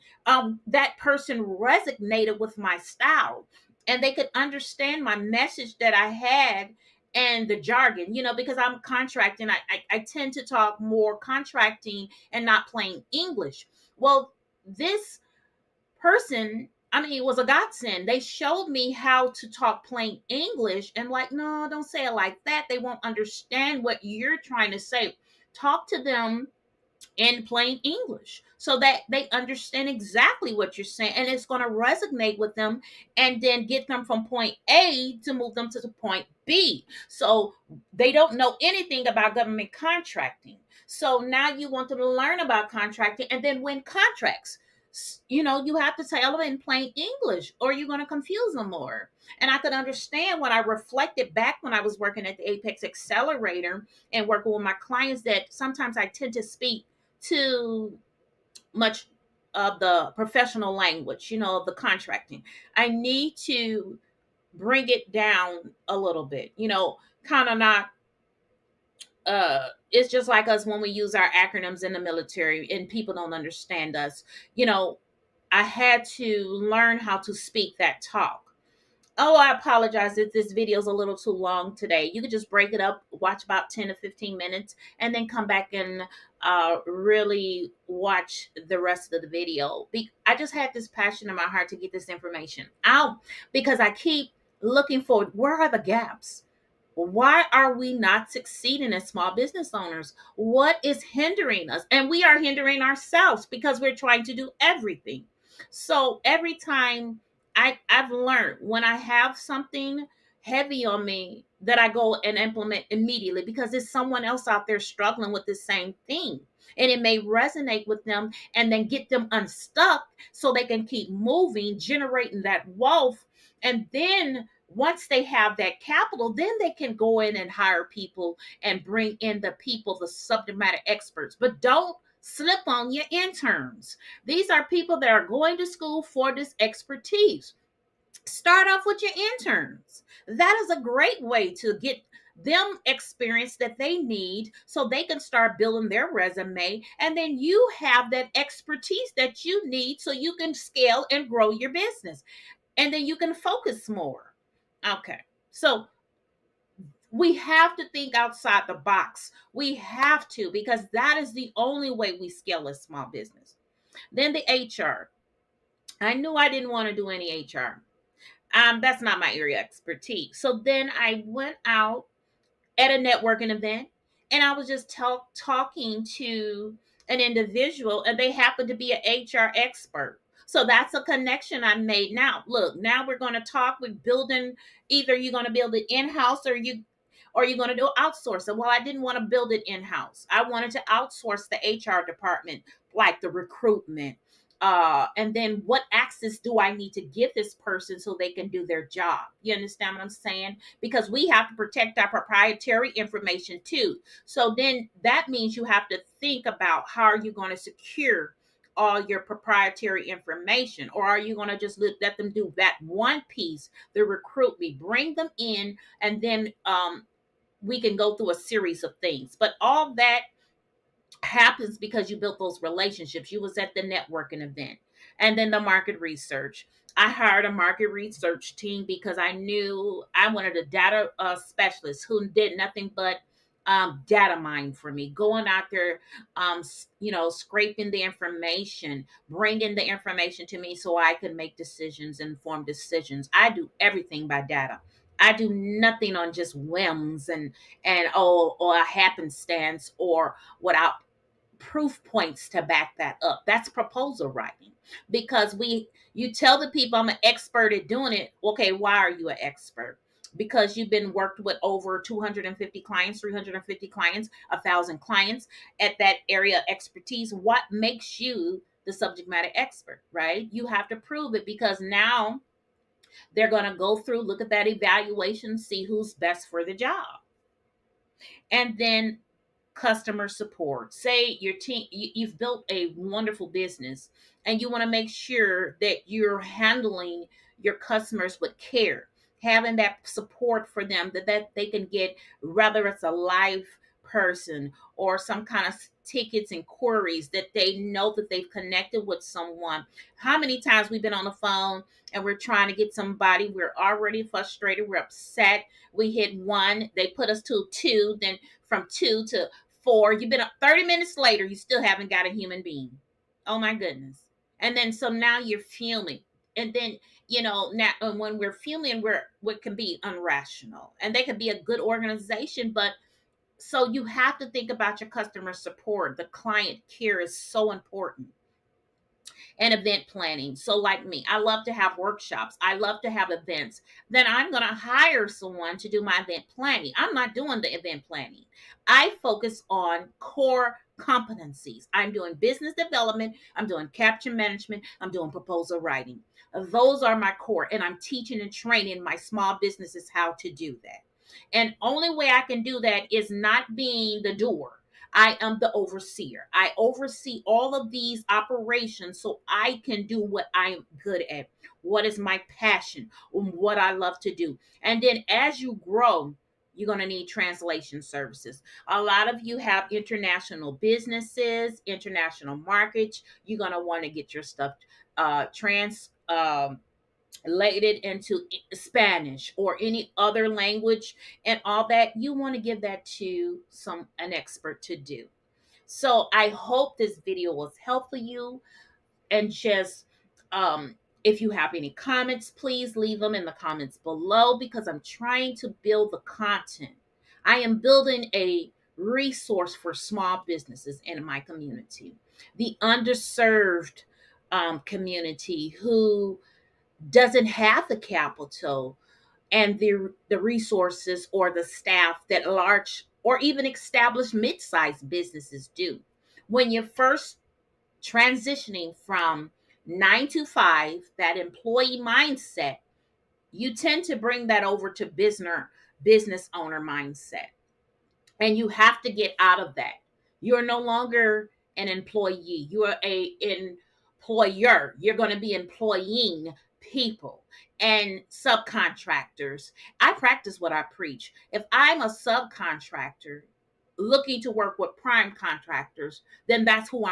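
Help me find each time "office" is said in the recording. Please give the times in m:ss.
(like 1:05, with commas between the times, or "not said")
not said.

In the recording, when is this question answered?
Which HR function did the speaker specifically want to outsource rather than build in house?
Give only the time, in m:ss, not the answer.
3:13.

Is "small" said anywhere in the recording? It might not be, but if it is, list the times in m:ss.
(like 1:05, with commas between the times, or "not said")
1:39, 2:42, 5:49, 6:39.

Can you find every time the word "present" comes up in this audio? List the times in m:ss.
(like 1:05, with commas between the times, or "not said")
not said.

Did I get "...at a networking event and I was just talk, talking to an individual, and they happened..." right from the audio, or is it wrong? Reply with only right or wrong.
right.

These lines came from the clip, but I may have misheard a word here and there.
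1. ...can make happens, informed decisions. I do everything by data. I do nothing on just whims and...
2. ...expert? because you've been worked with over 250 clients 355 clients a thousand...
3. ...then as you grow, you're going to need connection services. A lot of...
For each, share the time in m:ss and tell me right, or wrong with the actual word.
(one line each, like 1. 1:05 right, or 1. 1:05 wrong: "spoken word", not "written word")
1. 4:01 wrong: "decisions", not "happens"
2. 4:19 wrong: "350", not "355"
3. 6:05 wrong: "translation", not "connection".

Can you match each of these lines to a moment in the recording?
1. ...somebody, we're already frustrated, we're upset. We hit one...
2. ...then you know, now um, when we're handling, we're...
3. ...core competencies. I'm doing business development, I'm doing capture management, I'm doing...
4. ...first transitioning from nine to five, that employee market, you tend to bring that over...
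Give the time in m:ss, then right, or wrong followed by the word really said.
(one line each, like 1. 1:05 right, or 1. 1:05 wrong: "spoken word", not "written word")
1. 5:02 right
2. 5:16 wrong: "feeling", not "handling"
3. 5:40 right
4. 6:56 wrong: "mindset", not "market".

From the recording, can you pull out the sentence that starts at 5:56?
I oversee all of these operations so I can do what I'm good at.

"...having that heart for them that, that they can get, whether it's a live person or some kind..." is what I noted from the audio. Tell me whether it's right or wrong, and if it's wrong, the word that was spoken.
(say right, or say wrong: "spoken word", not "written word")
wrong: "support", not "heart".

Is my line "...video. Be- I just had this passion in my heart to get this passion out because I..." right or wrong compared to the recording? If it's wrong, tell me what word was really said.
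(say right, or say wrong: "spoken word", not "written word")
wrong: "information", not "passion".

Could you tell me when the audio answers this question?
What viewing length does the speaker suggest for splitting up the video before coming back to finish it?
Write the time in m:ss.
1:23.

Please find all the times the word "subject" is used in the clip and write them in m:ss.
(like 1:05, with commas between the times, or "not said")
2:10, 4:28.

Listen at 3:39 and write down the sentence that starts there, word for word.
But all that happens because you built those relationships.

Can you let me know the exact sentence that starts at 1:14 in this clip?
You know, I had to learn how to speak that talk.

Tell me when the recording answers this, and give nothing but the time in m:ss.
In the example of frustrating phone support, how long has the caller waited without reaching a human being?
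5:10.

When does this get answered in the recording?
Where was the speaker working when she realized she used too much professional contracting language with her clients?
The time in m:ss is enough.
0:52.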